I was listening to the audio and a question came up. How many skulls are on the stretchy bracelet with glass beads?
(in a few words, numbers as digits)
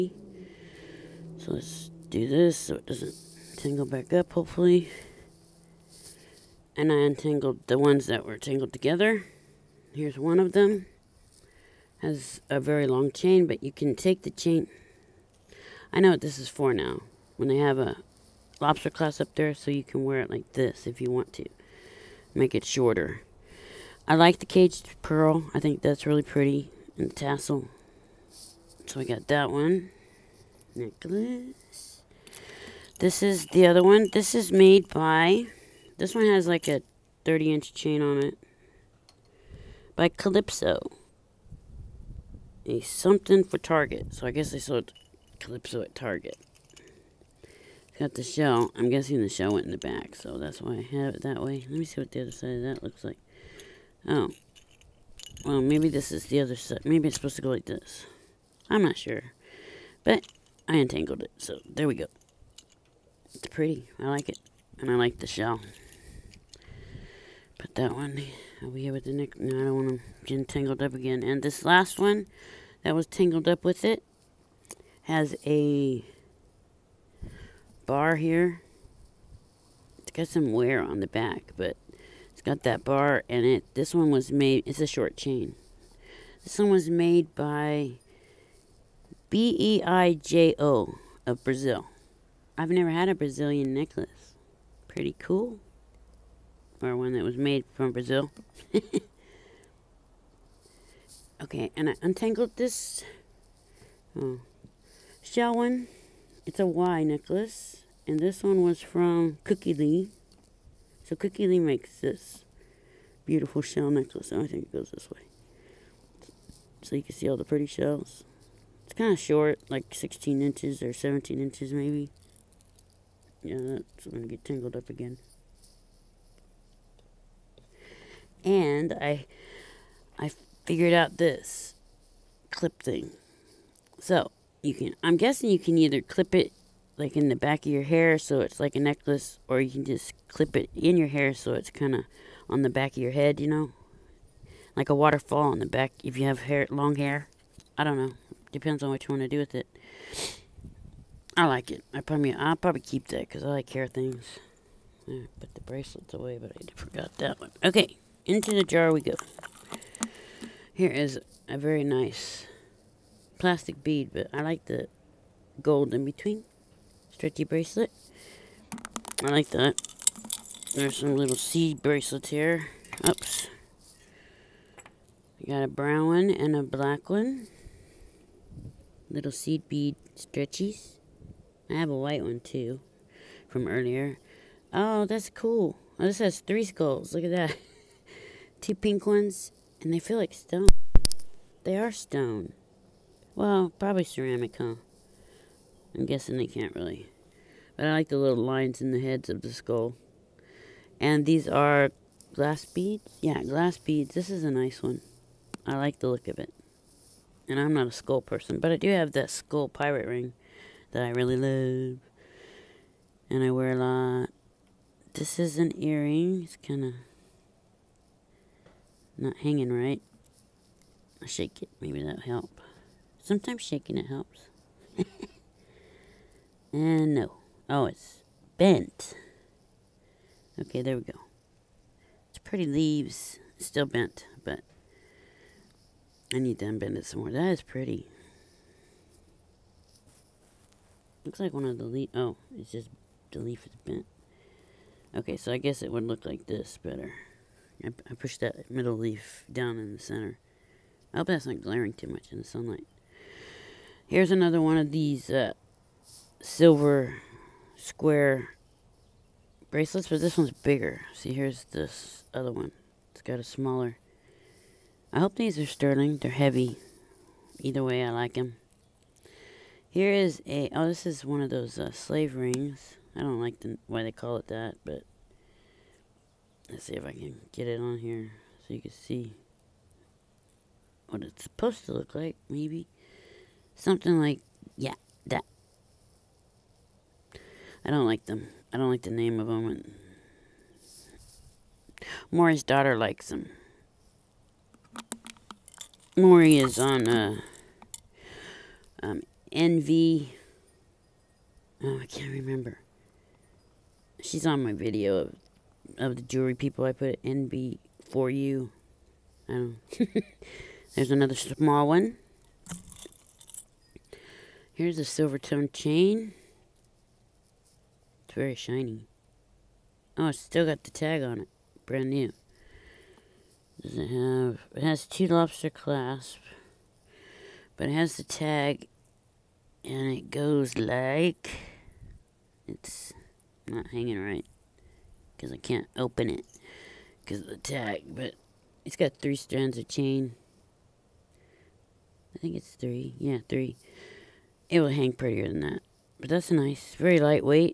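3.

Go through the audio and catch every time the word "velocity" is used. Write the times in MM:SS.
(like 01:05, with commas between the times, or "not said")
not said.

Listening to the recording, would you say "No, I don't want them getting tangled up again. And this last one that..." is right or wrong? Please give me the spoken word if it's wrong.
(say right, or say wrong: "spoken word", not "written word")
right.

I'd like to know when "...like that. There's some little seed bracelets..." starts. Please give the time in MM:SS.
02:49.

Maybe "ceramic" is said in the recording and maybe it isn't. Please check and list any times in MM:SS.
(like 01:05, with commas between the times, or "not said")
03:14.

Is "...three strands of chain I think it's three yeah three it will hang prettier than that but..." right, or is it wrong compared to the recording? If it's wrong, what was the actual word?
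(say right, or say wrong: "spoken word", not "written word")
right.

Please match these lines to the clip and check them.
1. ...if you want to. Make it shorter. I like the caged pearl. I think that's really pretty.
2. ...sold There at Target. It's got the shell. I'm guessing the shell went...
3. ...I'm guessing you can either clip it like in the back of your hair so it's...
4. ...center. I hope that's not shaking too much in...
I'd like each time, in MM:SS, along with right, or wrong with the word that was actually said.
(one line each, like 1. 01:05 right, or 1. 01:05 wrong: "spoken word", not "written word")
1. 00:20 right
2. 00:44 wrong: "Calypso", not "There"
3. 02:15 right
4. 04:09 wrong: "glaring", not "shaking".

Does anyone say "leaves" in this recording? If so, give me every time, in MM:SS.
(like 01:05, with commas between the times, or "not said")
03:52.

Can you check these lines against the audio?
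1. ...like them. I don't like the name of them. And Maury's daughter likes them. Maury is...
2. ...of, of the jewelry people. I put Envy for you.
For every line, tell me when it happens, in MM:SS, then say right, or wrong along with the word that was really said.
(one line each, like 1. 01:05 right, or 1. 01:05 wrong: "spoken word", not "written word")
1. 04:48 right
2. 05:05 right.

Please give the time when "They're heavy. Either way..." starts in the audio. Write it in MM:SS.
04:26.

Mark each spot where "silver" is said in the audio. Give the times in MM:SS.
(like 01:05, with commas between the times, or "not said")
04:16, 05:15.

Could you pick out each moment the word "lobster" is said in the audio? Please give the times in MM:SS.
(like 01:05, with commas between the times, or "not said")
00:18, 05:25.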